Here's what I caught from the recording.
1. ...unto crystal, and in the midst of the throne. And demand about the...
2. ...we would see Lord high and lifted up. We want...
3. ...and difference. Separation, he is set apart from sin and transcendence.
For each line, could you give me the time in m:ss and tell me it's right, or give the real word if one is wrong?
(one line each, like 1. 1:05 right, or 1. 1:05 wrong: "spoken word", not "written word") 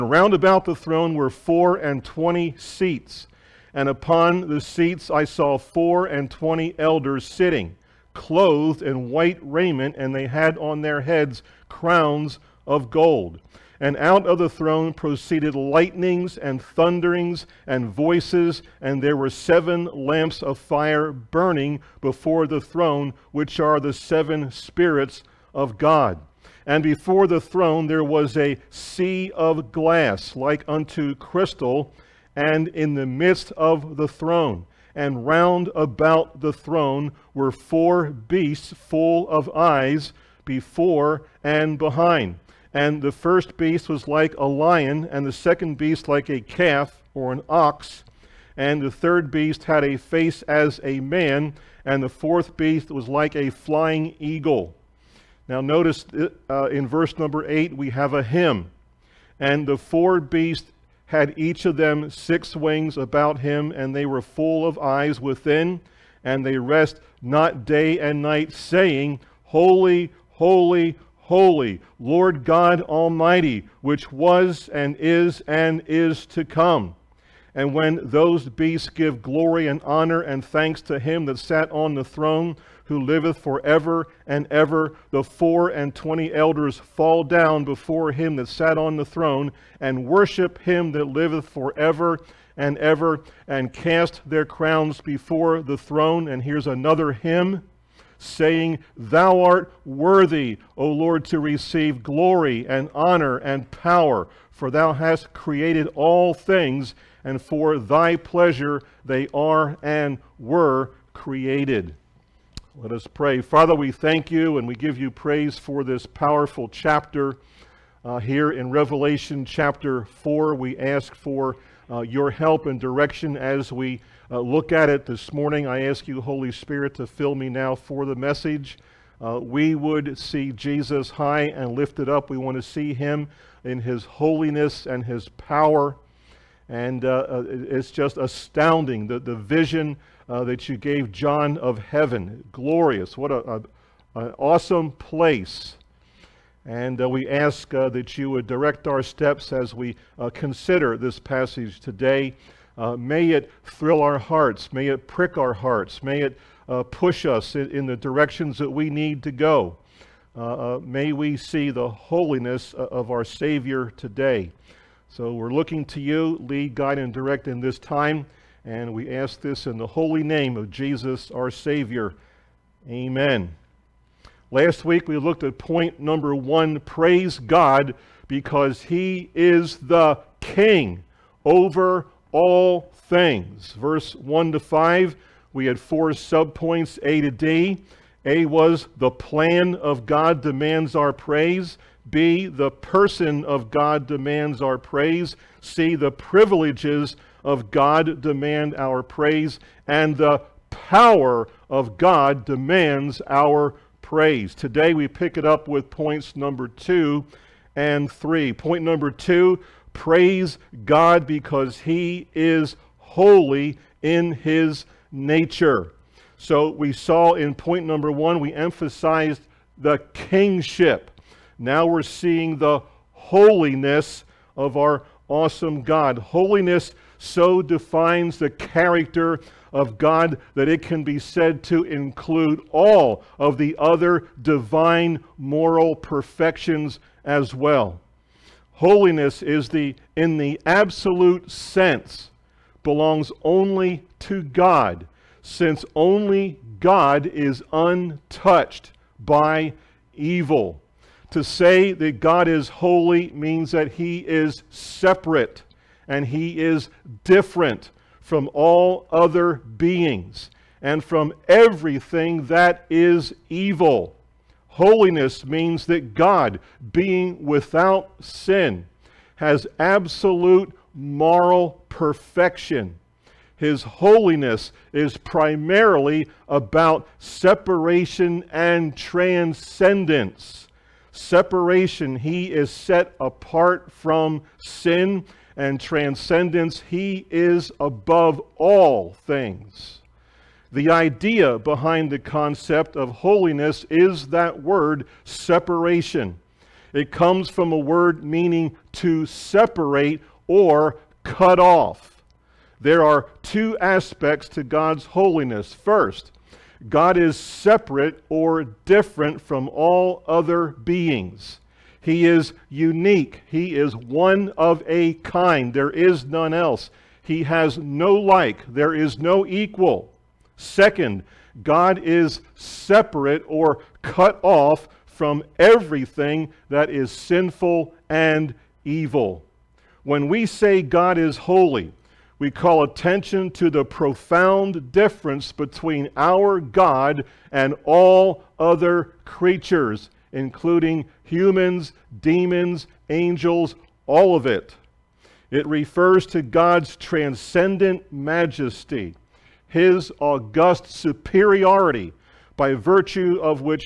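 1. 0:30 wrong: "round", not "demand"
2. 2:09 wrong: "Jesus", not "Lord"
3. 4:38 wrong: "transcendence", not "difference".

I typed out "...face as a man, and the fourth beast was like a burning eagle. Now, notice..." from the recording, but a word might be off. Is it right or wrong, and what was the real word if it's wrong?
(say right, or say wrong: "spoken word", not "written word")
wrong: "flying", not "burning".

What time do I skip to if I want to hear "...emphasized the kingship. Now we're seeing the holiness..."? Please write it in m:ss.
3:38.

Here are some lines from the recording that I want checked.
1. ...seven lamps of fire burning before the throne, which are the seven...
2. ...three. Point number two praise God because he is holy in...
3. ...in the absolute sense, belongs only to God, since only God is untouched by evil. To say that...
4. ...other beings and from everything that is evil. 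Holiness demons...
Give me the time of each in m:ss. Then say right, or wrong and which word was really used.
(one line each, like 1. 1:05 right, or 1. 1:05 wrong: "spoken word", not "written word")
1. 0:19 right
2. 3:28 right
3. 4:00 right
4. 4:19 wrong: "means", not "demons".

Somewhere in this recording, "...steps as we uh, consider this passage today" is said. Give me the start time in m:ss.
2:29.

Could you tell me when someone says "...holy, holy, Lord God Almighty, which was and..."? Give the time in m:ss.
1:10.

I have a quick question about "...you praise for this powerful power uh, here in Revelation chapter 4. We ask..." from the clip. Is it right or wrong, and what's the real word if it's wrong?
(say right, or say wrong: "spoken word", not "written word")
wrong: "chapter", not "power".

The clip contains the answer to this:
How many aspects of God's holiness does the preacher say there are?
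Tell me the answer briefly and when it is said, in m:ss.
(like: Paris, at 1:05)
2, at 5:03.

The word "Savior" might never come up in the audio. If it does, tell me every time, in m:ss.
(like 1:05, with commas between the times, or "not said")
2:43, 2:51.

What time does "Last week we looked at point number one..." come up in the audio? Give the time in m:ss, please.
2:54.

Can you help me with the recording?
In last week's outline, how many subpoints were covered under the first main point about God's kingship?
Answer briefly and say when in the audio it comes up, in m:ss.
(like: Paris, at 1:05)
4, at 3:05.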